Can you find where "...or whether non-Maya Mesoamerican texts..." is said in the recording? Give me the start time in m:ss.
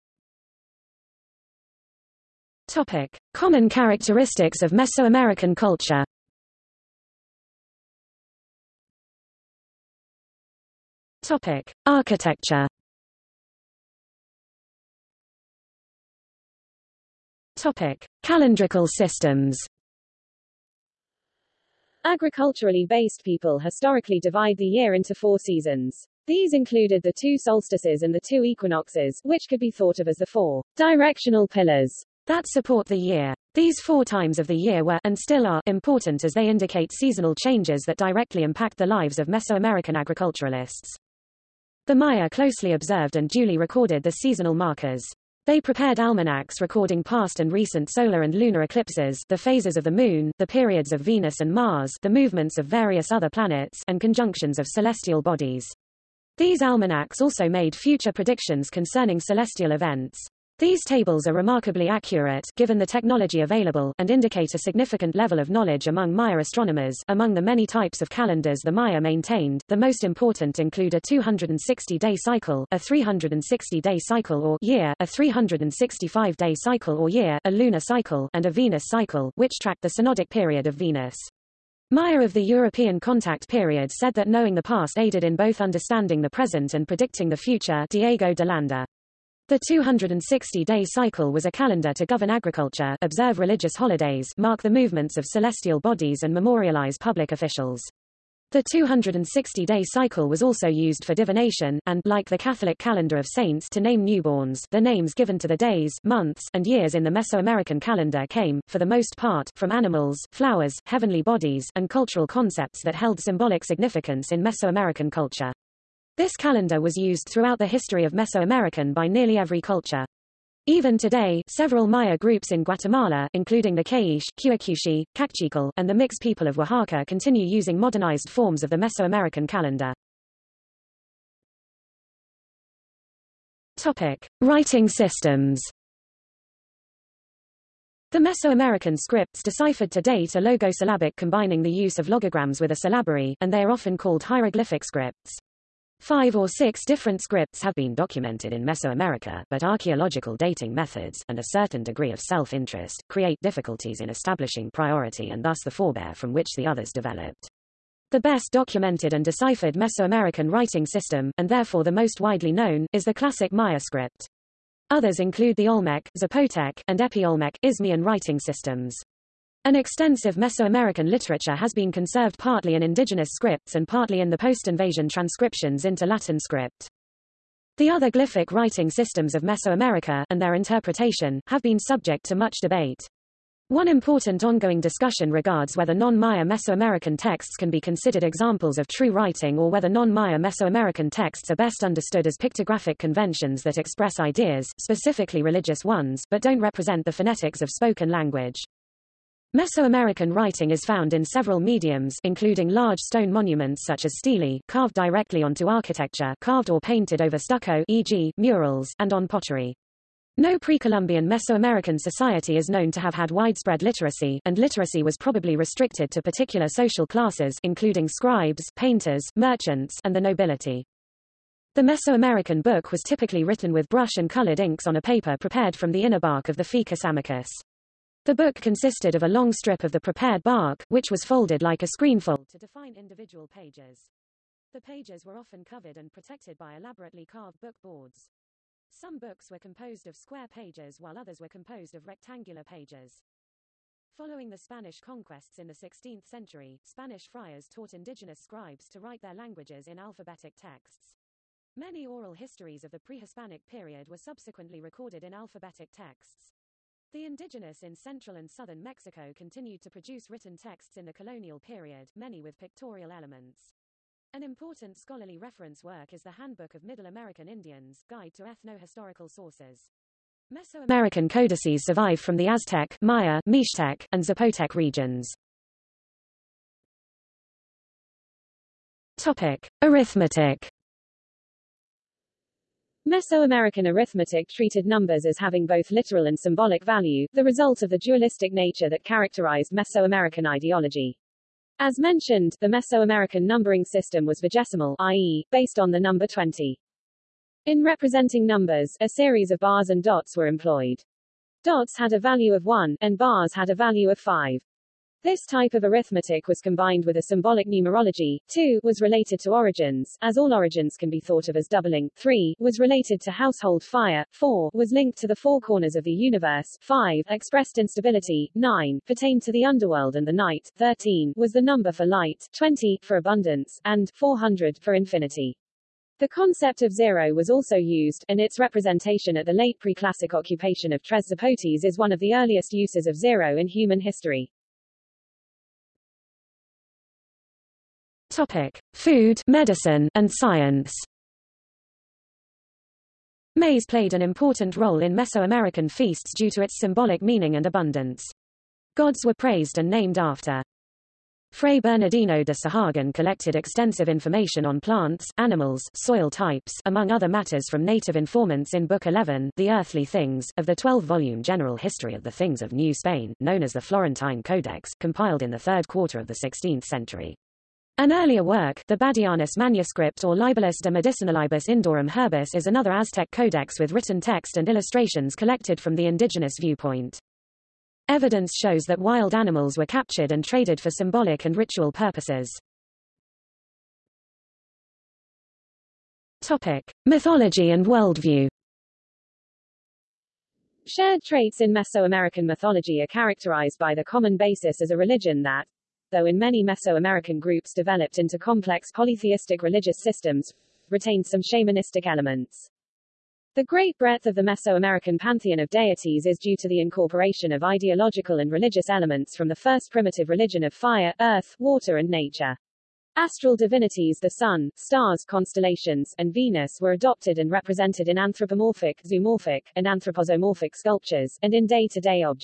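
3:09.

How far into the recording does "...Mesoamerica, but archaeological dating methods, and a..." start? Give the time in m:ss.
2:28.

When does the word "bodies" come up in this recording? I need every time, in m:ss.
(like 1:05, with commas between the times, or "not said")
0:55, 1:35, 1:51.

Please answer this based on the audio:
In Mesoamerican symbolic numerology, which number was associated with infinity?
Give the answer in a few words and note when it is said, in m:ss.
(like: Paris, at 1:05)
400, at 5:24.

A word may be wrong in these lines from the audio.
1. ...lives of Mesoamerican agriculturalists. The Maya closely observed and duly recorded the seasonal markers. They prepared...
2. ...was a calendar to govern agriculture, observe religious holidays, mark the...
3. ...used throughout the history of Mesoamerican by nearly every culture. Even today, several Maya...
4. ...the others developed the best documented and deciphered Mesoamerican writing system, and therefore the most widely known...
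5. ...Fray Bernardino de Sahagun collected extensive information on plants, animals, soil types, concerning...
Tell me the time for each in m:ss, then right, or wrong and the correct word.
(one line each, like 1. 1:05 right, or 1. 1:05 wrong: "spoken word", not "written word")
1. 0:38 right
2. 1:31 right
3. 1:56 right
4. 2:36 right
5. 5:51 wrong: "among", not "concerning".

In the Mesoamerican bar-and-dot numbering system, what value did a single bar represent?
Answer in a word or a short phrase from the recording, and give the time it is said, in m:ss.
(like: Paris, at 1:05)
5, at 5:03.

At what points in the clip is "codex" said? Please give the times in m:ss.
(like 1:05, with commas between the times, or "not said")
6:04, 6:13.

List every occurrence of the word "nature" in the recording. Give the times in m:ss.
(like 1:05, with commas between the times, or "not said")
4:48, 6:52.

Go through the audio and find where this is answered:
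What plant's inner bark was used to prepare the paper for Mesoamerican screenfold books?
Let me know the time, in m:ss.
3:46.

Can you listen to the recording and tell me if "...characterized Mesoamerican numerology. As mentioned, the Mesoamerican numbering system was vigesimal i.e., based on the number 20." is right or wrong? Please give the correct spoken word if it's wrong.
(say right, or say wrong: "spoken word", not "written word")
wrong: "ideology", not "numerology".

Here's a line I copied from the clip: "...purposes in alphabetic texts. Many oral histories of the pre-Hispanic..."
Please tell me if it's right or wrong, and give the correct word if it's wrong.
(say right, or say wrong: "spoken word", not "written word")
wrong: "languages", not "purposes".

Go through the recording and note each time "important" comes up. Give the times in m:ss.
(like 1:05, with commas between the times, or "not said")
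0:35, 1:10, 3:03, 4:24, 5:44.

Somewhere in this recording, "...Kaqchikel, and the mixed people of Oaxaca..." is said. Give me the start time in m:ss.
2:05.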